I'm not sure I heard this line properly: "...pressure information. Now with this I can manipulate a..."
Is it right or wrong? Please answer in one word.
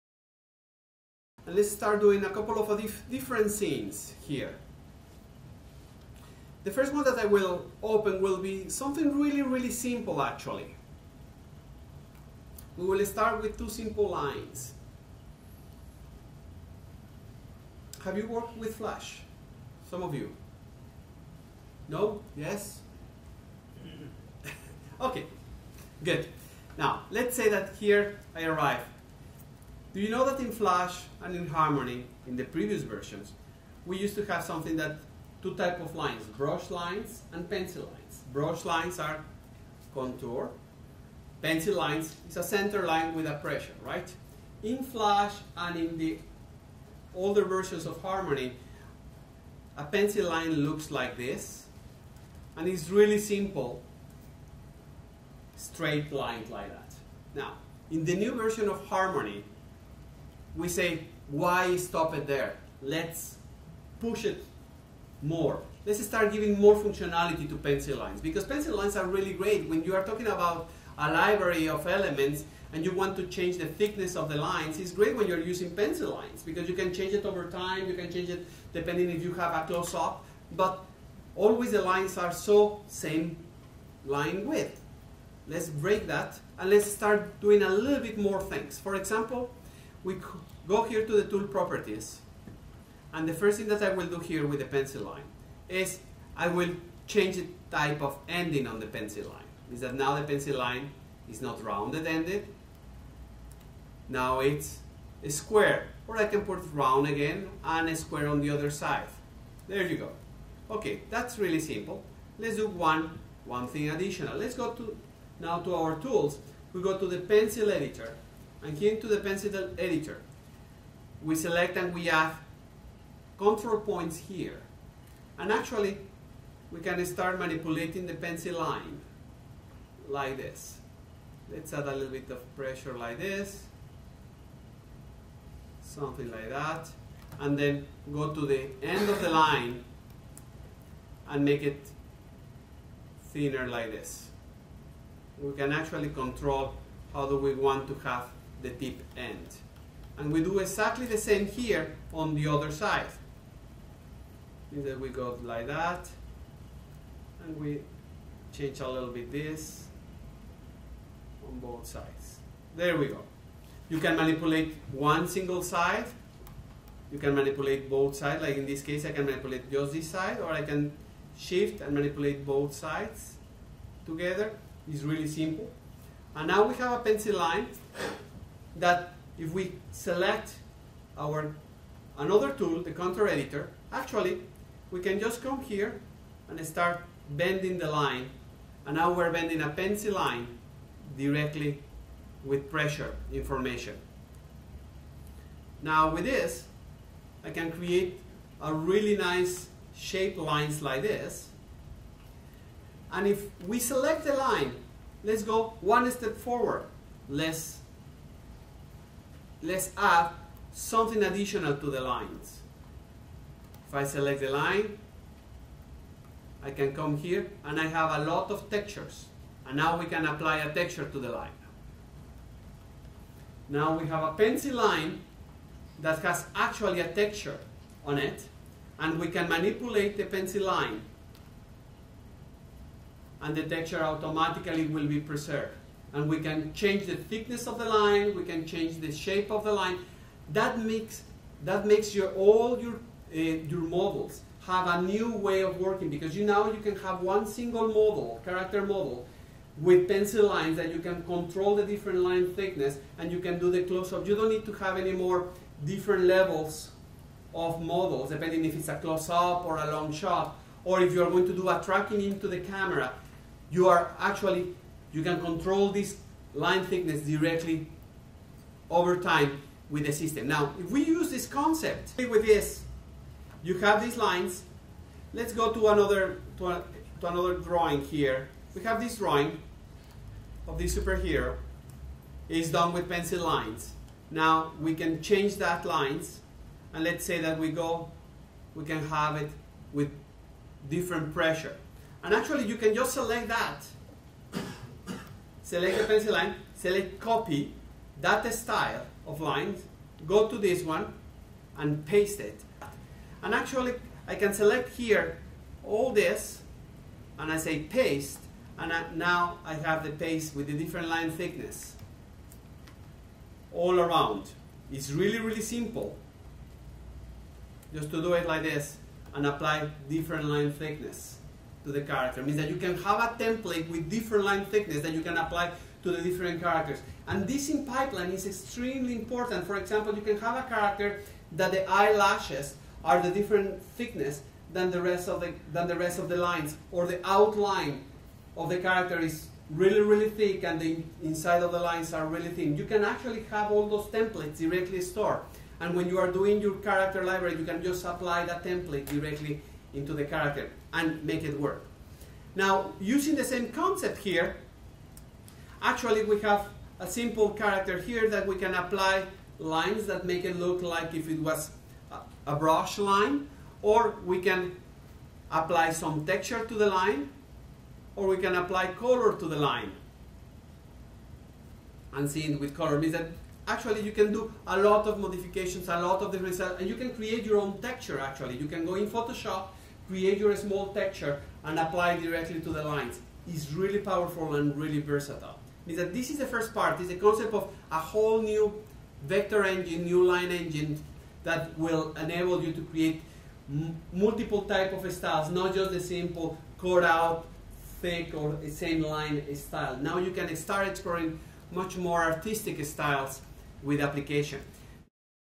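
wrong.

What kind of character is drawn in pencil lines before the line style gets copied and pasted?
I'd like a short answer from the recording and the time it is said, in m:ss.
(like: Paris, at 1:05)
superhero, at 4:40.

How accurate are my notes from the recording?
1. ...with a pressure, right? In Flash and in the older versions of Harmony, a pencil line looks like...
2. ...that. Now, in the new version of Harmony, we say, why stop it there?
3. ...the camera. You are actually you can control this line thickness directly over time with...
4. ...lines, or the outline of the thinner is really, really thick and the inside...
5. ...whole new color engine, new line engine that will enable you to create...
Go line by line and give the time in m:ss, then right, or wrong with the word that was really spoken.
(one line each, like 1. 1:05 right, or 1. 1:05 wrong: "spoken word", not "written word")
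1. 0:43 right
2. 0:56 right
3. 4:22 right
4. 5:36 wrong: "character", not "thinner"
5. 6:28 wrong: "vector", not "color".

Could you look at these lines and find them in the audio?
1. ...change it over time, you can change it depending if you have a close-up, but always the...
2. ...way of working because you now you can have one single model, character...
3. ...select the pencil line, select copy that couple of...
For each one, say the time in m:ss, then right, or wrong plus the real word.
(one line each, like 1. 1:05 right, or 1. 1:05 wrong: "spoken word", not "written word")
1. 1:16 right
2. 4:05 right
3. 4:55 wrong: "style", not "couple".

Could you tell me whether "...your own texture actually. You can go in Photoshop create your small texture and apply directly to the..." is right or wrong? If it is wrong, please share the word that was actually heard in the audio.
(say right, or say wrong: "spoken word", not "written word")
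right.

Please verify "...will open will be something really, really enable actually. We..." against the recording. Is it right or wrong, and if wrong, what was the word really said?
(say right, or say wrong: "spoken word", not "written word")
wrong: "simple", not "enable".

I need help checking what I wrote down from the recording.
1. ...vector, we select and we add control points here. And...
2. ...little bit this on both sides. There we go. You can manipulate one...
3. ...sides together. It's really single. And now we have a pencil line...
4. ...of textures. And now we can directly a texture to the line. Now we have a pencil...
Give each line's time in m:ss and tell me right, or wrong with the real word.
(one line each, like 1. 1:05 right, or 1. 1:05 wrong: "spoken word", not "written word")
1. 1:59 wrong: "editor", not "vector"
2. 2:38 right
3. 2:52 wrong: "simple", not "single"
4. 3:38 wrong: "apply", not "directly".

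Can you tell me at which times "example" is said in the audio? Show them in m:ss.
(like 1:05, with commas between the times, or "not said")
1:28, 5:29.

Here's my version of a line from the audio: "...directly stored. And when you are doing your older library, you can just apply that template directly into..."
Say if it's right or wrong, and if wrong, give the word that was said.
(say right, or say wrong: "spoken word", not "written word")
wrong: "character", not "older".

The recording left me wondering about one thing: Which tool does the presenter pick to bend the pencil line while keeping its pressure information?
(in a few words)
contour editor.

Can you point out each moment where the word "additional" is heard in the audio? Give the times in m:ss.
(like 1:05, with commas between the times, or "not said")
1:53, 3:31.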